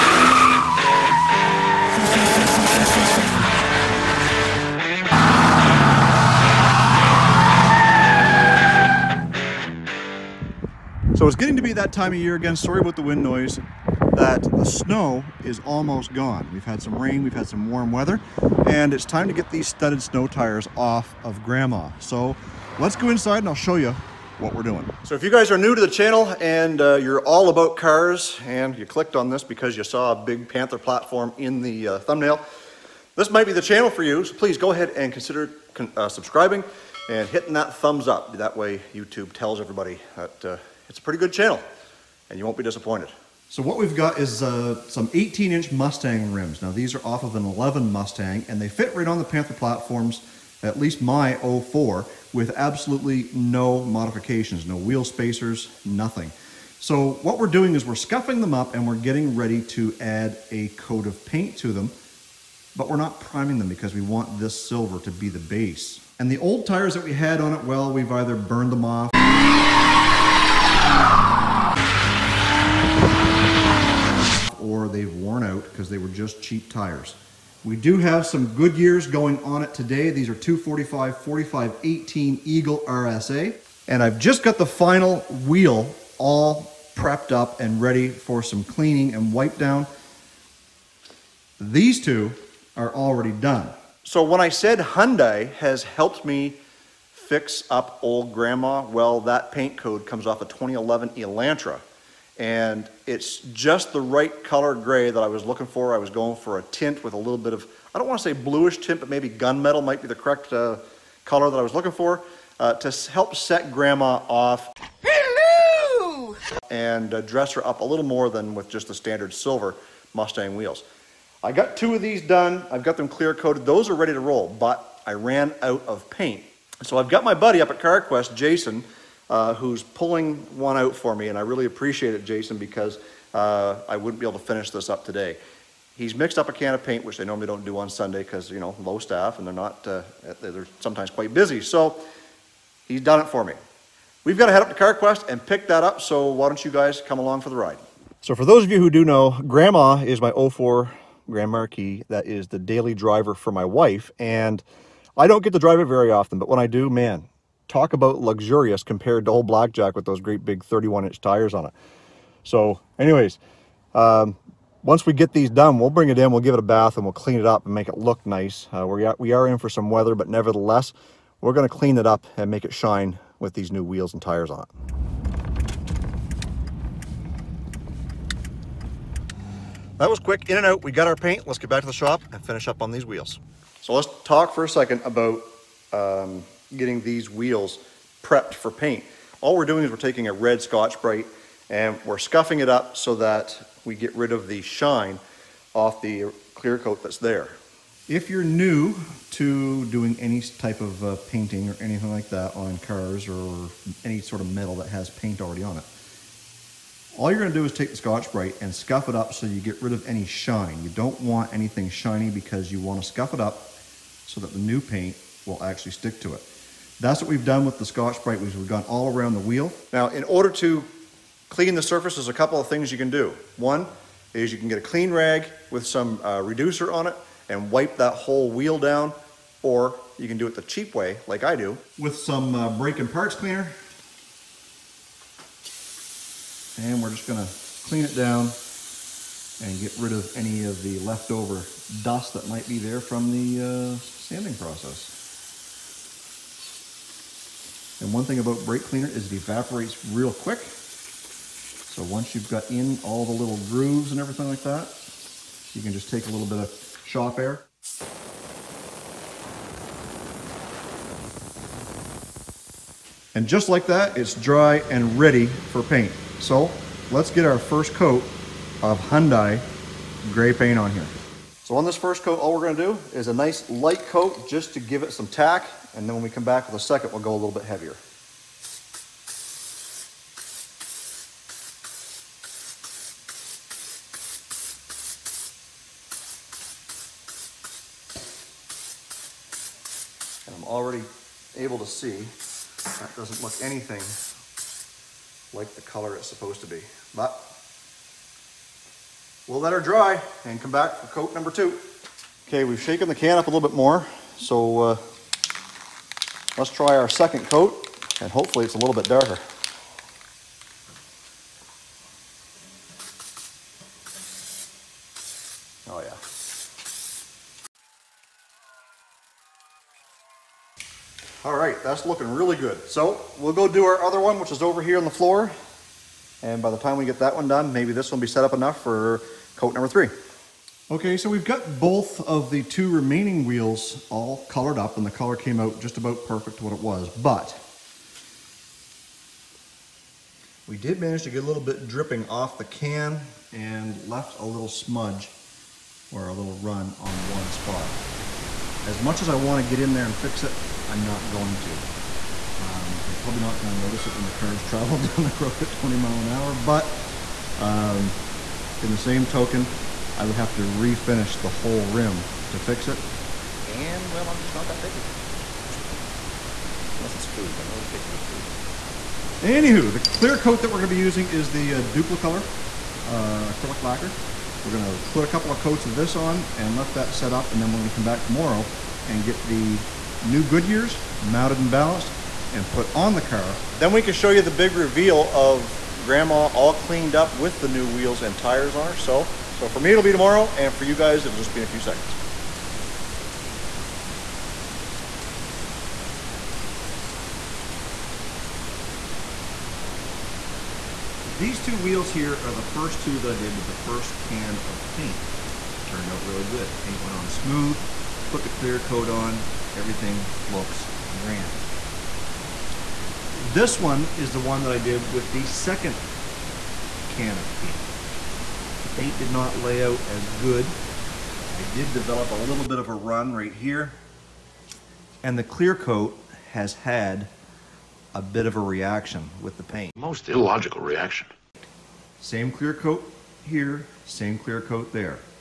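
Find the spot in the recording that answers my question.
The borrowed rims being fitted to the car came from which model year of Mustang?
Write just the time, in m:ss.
0:47.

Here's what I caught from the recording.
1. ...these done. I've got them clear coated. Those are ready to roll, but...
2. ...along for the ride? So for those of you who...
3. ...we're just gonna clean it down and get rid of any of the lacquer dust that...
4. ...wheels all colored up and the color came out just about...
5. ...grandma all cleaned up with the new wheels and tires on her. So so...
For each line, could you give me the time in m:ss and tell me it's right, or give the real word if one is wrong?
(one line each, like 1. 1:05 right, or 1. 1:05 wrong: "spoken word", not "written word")
1. 2:02 right
2. 2:27 right
3. 3:57 wrong: "leftover", not "lacquer"
4. 5:33 right
5. 6:26 right.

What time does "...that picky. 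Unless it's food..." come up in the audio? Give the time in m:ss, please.
6:04.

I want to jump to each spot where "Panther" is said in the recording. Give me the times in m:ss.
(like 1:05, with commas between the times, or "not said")
0:30, 0:49.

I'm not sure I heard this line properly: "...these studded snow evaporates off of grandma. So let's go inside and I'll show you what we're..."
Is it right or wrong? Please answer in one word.
wrong.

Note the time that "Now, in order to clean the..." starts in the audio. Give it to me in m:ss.
3:39.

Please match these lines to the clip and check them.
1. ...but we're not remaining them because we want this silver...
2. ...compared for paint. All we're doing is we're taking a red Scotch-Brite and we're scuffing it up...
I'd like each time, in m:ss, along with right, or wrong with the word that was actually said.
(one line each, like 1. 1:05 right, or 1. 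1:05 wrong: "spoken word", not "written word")
1. 1:02 wrong: "priming", not "remaining"
2. 3:08 wrong: "prepped", not "compared".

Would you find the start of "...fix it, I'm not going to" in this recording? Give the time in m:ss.
5:50.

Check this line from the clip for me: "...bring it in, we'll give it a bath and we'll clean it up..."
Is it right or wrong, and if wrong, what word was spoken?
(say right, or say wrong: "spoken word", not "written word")
right.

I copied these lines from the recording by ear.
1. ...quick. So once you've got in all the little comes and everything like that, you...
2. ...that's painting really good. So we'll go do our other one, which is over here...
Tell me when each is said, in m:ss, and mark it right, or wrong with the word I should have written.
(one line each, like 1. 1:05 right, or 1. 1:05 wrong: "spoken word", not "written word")
1. 4:10 wrong: "grooves", not "comes"
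2. 5:21 wrong: "looking", not "painting".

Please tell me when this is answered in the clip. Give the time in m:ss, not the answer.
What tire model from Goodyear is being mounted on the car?
1:22.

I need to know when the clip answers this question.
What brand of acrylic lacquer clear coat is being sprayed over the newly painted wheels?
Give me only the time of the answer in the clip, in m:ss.
6:11.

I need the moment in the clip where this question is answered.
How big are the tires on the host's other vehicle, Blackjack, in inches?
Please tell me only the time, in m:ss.
2:40.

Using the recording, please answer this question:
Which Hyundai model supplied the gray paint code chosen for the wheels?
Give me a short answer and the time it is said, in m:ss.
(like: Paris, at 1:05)
Elantra, at 1:41.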